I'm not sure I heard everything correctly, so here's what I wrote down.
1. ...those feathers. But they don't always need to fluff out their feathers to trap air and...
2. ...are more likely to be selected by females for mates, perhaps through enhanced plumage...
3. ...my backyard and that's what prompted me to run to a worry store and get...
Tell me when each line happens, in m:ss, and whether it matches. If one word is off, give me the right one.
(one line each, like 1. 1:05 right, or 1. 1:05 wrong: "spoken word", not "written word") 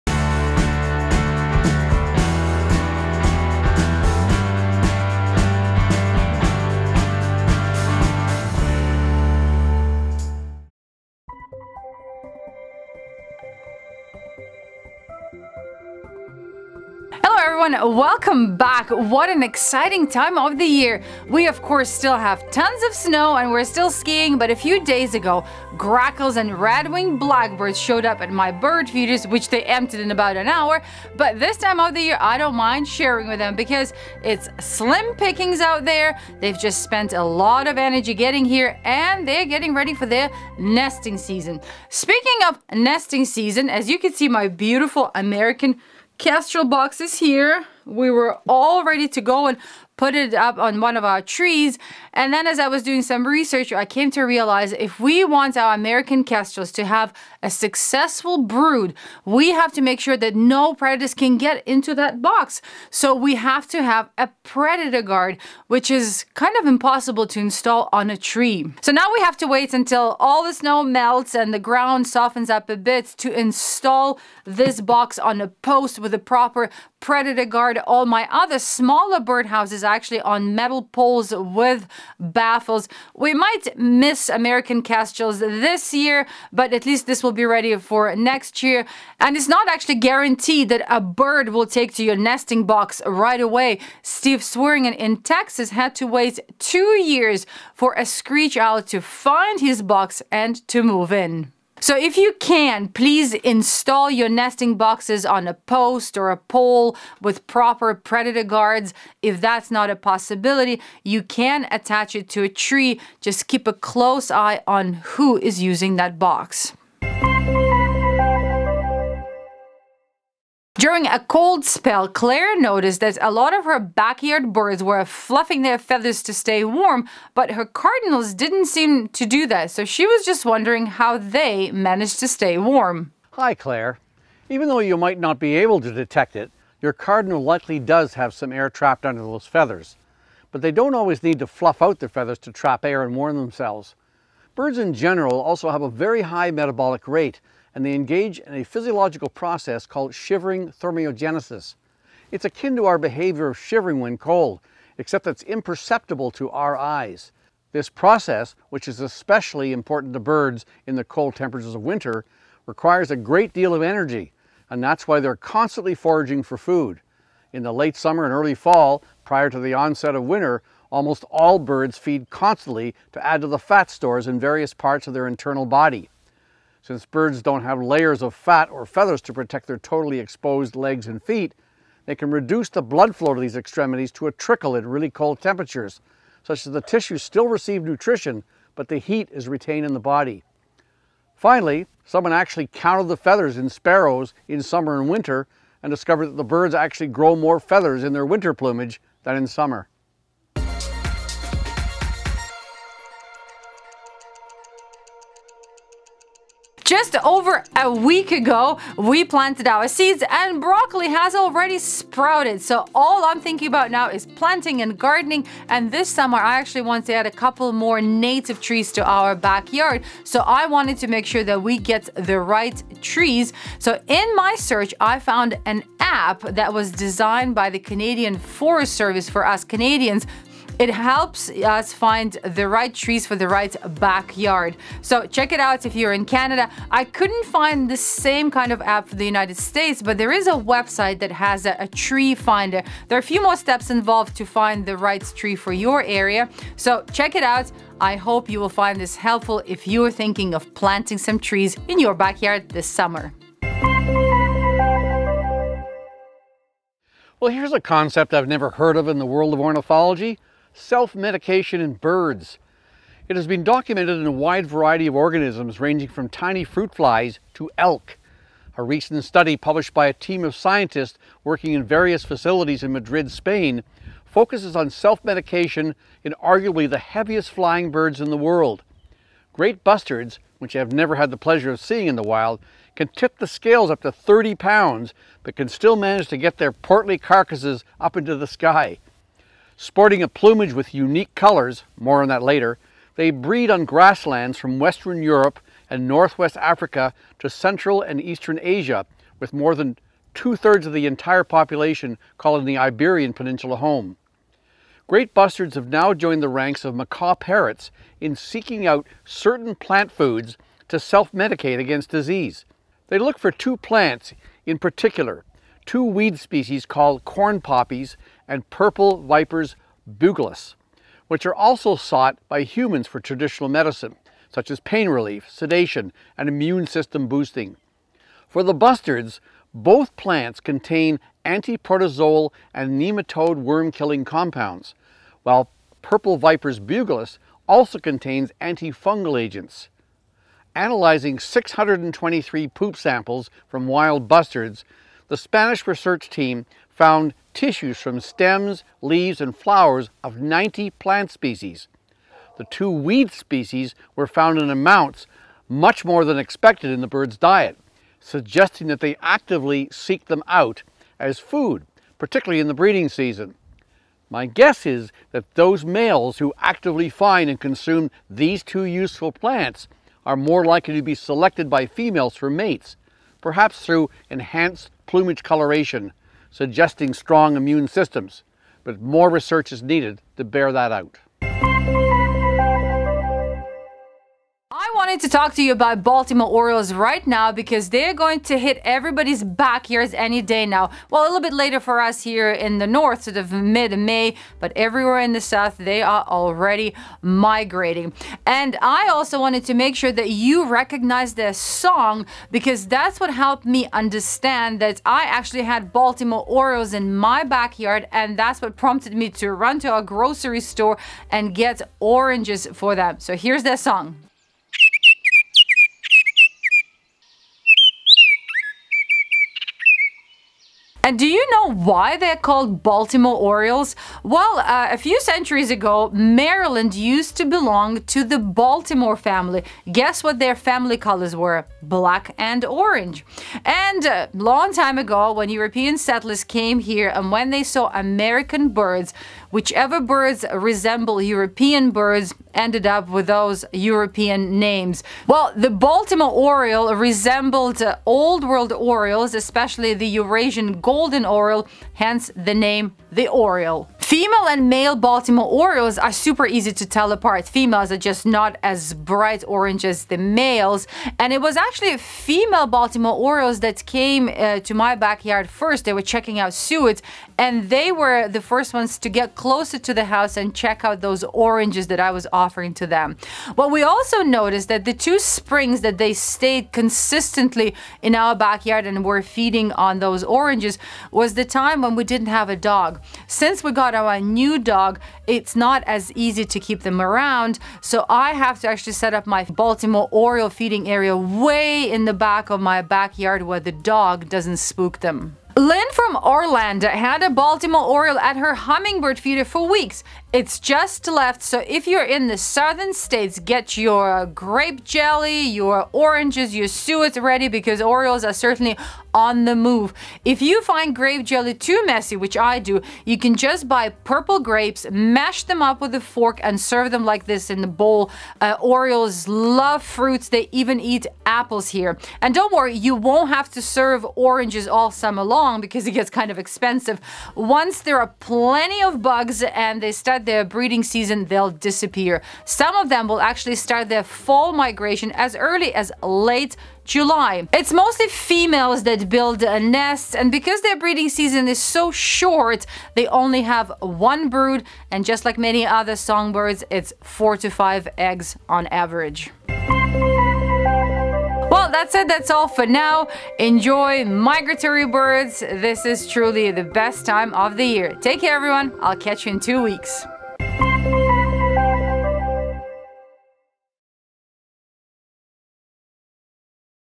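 1. 2:19 right
2. 6:10 right
3. 6:47 wrong: "grocery", not "worry".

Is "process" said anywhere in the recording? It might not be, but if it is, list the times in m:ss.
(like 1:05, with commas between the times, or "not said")
2:29, 2:37.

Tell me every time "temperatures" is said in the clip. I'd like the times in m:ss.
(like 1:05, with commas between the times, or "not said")
2:41, 3:05.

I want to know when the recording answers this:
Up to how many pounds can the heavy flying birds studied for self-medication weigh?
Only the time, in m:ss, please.
4:44.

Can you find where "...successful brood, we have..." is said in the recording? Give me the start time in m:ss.
0:57.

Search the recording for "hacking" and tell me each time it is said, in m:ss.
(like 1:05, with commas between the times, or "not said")
not said.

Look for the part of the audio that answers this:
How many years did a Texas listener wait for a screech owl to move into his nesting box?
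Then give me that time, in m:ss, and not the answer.
1:36.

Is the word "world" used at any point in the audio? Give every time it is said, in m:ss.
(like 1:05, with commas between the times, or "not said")
4:19, 4:38, 7:28.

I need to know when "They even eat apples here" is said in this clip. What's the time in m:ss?
8:40.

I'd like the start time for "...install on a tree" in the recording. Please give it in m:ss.
1:07.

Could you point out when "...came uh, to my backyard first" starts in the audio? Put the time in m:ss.
7:43.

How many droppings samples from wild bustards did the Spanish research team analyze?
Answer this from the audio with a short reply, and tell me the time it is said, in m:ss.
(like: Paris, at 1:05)
623, at 5:41.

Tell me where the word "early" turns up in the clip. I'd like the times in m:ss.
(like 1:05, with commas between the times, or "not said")
2:48, 8:55.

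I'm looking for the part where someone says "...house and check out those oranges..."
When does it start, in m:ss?
7:50.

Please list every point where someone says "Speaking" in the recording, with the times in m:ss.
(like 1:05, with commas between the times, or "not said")
0:41.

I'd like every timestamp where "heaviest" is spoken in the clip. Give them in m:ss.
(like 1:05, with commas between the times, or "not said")
4:36.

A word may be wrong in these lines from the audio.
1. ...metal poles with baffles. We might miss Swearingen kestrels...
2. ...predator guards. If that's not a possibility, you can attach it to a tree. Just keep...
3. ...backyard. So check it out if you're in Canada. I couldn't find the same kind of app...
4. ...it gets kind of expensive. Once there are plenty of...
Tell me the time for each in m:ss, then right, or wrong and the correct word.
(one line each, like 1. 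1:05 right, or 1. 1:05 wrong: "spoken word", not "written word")
1. 1:20 wrong: "American", not "Swearingen"
2. 1:47 right
3. 3:53 right
4. 8:45 right.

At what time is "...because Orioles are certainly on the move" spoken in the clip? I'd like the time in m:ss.
8:27.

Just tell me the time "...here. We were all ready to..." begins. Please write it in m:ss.
0:47.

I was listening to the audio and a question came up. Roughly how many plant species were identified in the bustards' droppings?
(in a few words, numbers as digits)
90.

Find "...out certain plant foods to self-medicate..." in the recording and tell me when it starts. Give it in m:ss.
5:08.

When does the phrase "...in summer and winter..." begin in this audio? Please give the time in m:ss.
3:14.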